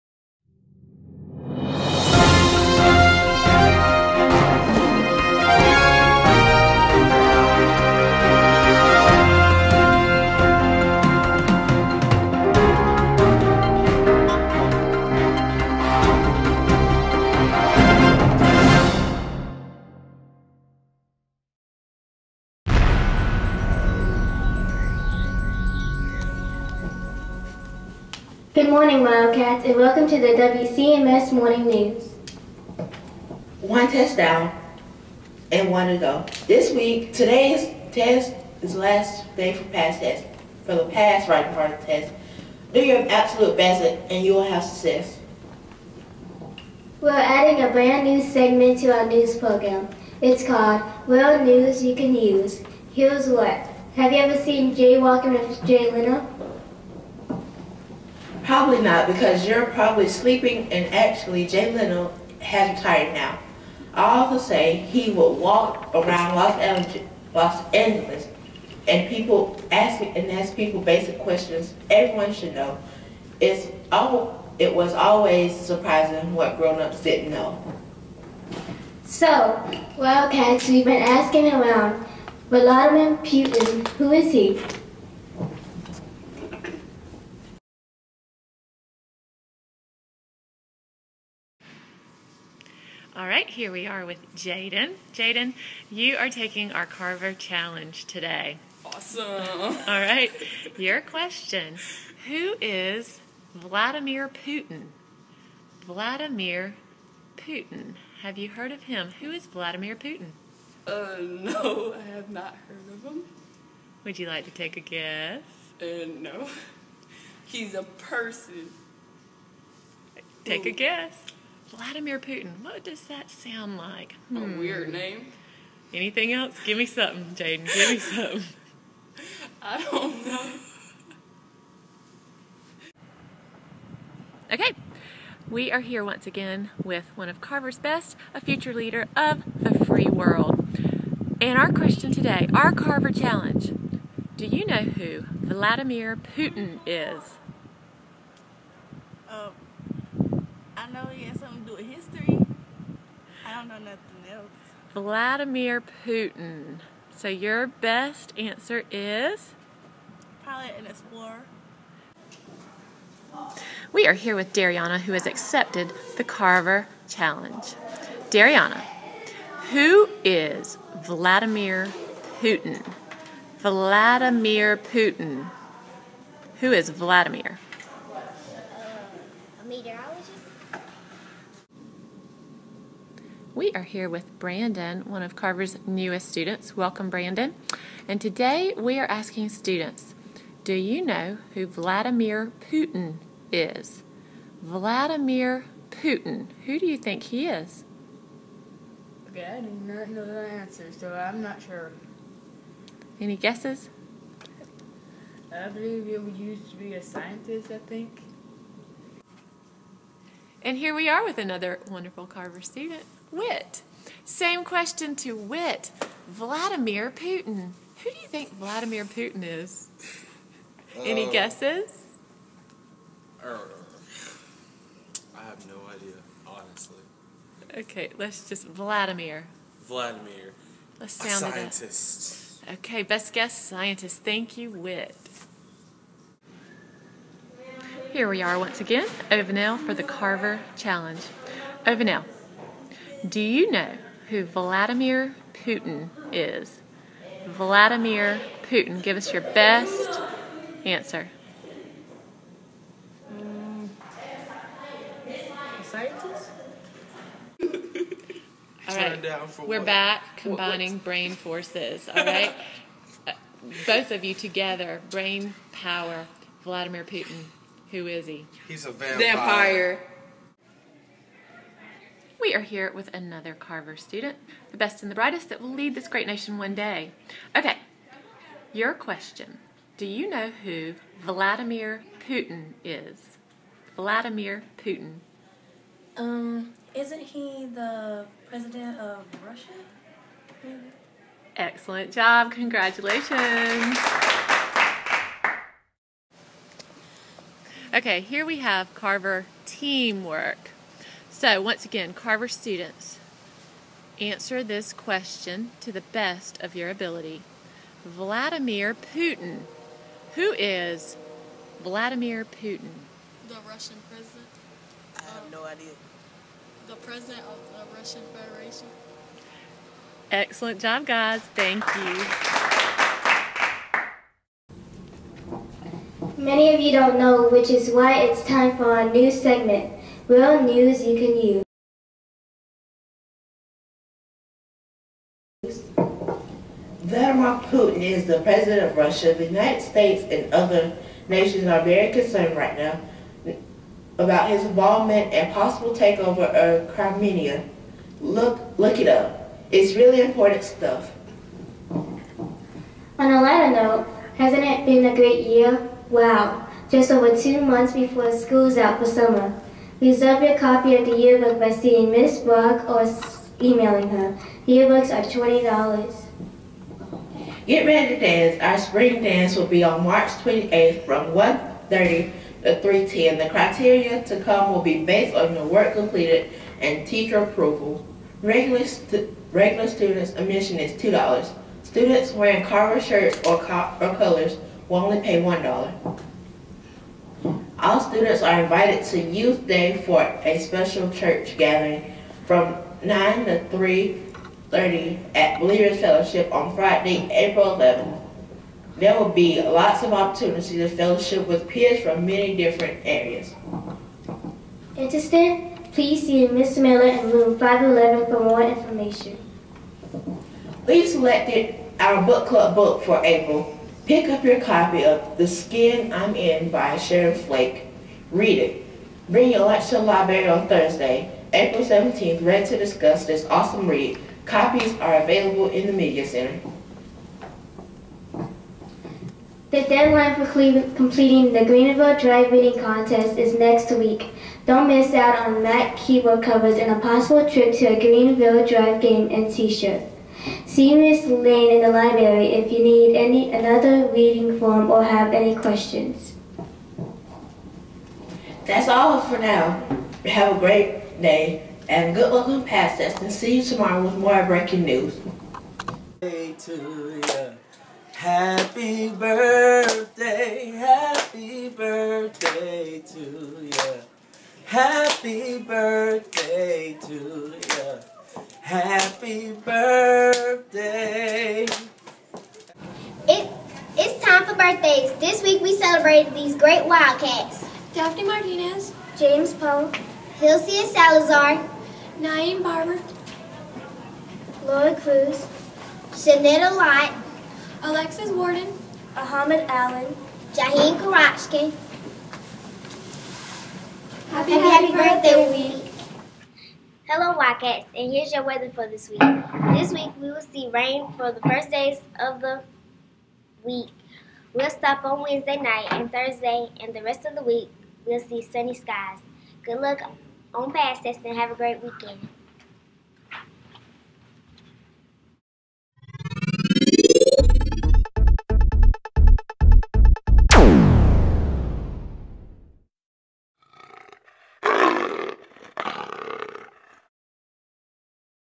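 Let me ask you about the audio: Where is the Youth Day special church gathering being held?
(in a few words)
Believers Fellowship.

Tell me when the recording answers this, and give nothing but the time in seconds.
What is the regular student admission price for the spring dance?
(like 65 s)
380 s.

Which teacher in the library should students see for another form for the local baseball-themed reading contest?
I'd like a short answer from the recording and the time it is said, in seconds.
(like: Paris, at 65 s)
Miss Lane, at 440 s.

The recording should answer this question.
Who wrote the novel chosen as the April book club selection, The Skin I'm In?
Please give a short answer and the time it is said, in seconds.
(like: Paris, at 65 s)
Sharon Flake, at 416 s.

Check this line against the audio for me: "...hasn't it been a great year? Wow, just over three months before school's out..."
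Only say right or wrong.
wrong.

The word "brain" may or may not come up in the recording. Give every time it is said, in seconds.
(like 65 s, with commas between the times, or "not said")
261 s, 265 s.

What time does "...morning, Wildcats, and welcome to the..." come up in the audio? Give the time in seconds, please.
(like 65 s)
28 s.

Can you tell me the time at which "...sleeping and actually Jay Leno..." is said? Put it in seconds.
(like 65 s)
60 s.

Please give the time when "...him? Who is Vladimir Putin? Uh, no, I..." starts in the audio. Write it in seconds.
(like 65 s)
108 s.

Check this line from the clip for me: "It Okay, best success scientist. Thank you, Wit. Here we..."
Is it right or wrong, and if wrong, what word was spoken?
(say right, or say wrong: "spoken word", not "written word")
wrong: "guess", not "success".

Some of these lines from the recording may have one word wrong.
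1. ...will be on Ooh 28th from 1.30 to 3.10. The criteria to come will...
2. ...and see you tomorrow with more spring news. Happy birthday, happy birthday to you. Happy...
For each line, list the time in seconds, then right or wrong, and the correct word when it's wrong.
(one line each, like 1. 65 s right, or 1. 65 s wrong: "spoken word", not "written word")
1. 369 s wrong: "March", not "Ooh"
2. 453 s wrong: "breaking", not "spring".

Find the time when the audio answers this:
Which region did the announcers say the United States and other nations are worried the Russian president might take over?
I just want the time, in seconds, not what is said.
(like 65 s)
346 s.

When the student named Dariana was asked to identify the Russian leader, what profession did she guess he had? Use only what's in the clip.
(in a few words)
meteorologist.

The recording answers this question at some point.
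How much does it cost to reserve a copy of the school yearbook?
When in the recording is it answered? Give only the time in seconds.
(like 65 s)
365 s.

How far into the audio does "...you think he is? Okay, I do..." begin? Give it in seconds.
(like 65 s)
196 s.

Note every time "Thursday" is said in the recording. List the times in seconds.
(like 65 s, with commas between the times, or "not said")
420 s, 506 s.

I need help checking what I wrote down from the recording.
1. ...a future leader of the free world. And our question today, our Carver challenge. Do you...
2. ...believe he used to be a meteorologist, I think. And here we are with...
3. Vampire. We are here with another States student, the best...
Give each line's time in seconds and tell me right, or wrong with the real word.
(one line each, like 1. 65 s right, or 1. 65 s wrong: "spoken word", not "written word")
1. 138 s right
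2. 205 s wrong: "scientist", not "meteorologist"
3. 269 s wrong: "Carver", not "States".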